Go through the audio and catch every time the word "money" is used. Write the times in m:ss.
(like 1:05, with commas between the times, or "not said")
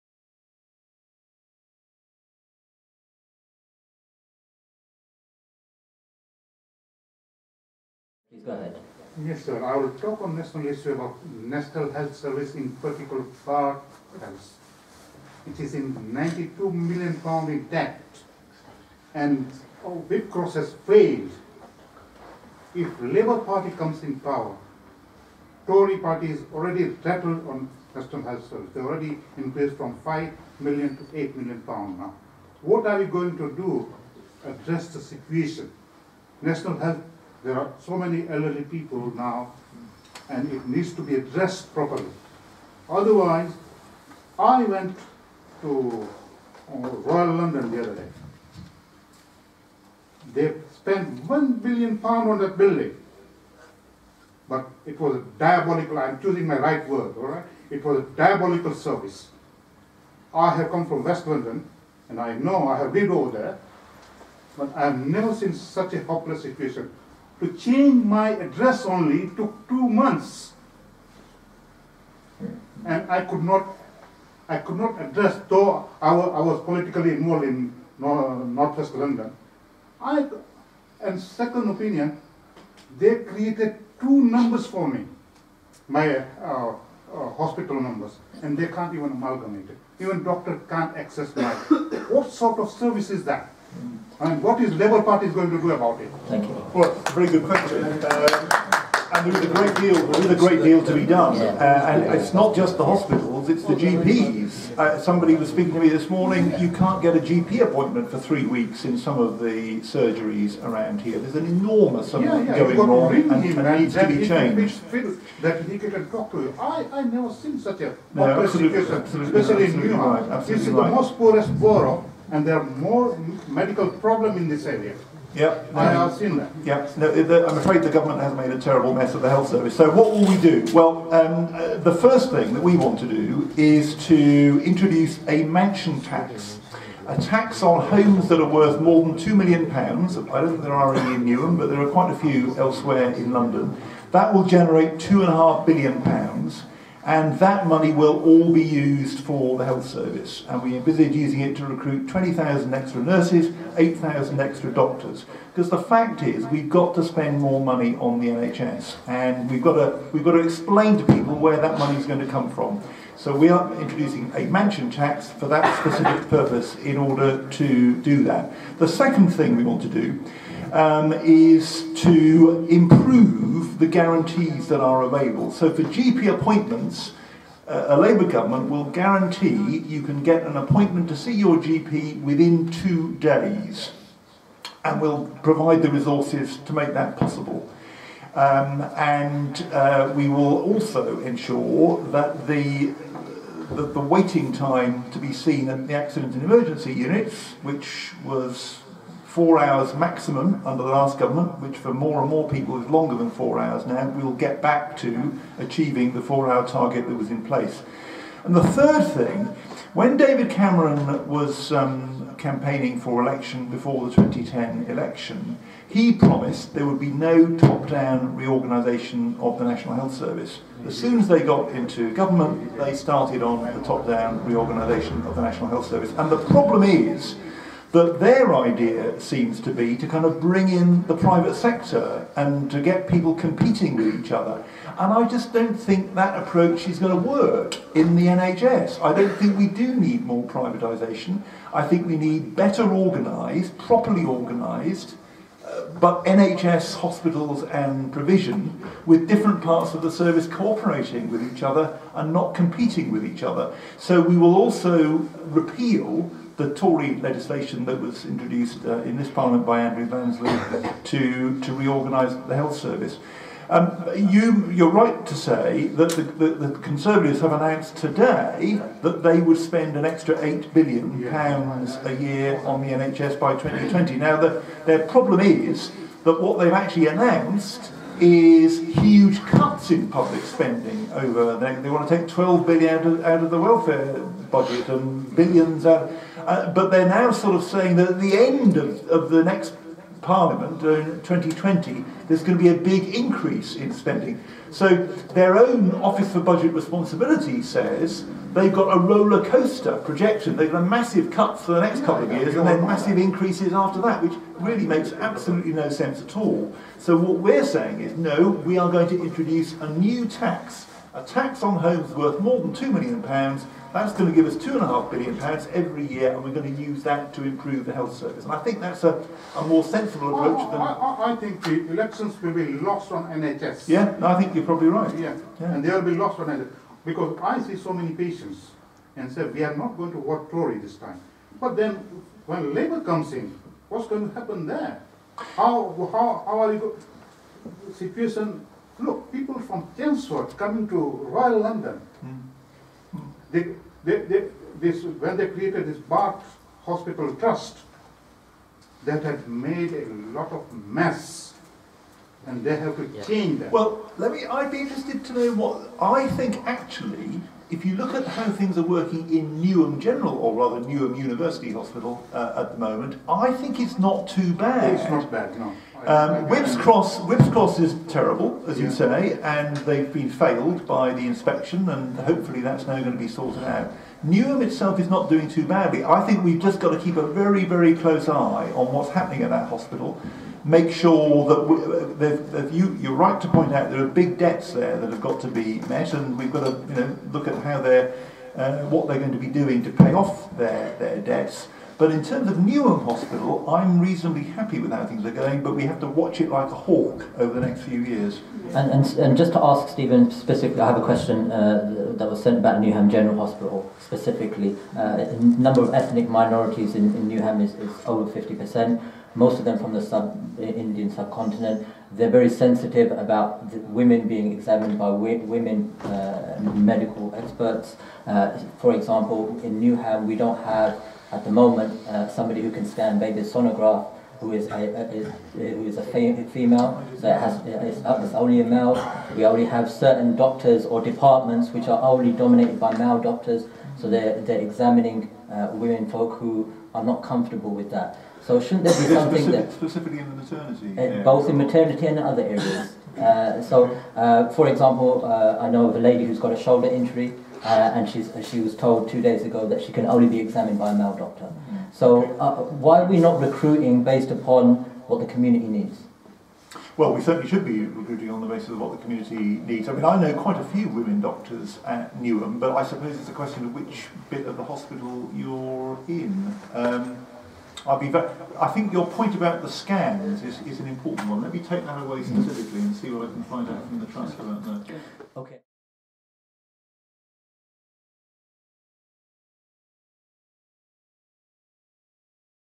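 2:27, 2:37, 2:41.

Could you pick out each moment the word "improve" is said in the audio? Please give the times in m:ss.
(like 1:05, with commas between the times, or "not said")
2:52, 5:17.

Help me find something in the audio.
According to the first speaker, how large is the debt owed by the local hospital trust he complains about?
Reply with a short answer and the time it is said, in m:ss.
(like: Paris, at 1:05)
92 million pounds, at 0:16.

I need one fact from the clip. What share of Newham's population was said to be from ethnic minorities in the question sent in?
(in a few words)
over 50%.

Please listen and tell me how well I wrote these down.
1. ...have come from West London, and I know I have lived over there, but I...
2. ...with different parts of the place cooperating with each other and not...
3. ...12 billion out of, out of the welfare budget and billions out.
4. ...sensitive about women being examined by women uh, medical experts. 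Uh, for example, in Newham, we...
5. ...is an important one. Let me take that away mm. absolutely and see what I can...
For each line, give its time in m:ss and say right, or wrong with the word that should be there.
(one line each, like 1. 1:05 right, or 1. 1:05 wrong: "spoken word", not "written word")
1. 1:00 right
2. 4:09 wrong: "service", not "place"
3. 4:42 right
4. 6:52 right
5. 7:50 wrong: "specifically", not "absolutely".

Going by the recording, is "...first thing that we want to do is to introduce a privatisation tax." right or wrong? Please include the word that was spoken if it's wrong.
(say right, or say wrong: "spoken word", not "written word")
wrong: "mansion", not "privatisation".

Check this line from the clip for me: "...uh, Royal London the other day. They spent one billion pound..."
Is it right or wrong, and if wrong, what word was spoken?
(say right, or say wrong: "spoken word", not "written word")
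right.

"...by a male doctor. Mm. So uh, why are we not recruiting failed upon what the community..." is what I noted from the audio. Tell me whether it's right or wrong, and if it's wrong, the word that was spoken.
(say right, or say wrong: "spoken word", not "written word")
wrong: "based", not "failed".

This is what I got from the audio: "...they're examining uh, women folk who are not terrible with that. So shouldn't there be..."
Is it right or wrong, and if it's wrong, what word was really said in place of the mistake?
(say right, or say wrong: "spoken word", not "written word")
wrong: "comfortable", not "terrible".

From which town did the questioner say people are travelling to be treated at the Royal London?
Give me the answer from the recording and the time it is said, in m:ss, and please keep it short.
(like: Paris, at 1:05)
Chelmsford, at 5:39.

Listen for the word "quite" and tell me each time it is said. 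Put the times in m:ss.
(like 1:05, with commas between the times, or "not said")
2:21, 7:40.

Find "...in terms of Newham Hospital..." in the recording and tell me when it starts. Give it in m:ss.
6:32.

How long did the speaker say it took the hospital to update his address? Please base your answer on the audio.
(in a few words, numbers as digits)
2 months.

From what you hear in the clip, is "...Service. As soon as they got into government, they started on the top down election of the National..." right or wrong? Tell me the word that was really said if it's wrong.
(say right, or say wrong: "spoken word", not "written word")
wrong: "reorganisation", not "election".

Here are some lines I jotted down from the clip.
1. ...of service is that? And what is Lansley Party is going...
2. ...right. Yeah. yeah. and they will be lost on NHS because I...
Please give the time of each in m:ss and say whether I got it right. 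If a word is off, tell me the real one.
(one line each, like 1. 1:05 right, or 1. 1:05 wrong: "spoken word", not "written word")
1. 1:32 wrong: "Labour", not "Lansley"
2. 5:24 right.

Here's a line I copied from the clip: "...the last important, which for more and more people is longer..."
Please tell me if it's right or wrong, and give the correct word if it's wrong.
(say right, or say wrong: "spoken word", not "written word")
wrong: "government", not "important".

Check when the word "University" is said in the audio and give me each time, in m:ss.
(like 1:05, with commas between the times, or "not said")
6:01.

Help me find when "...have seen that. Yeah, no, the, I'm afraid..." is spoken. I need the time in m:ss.
2:05.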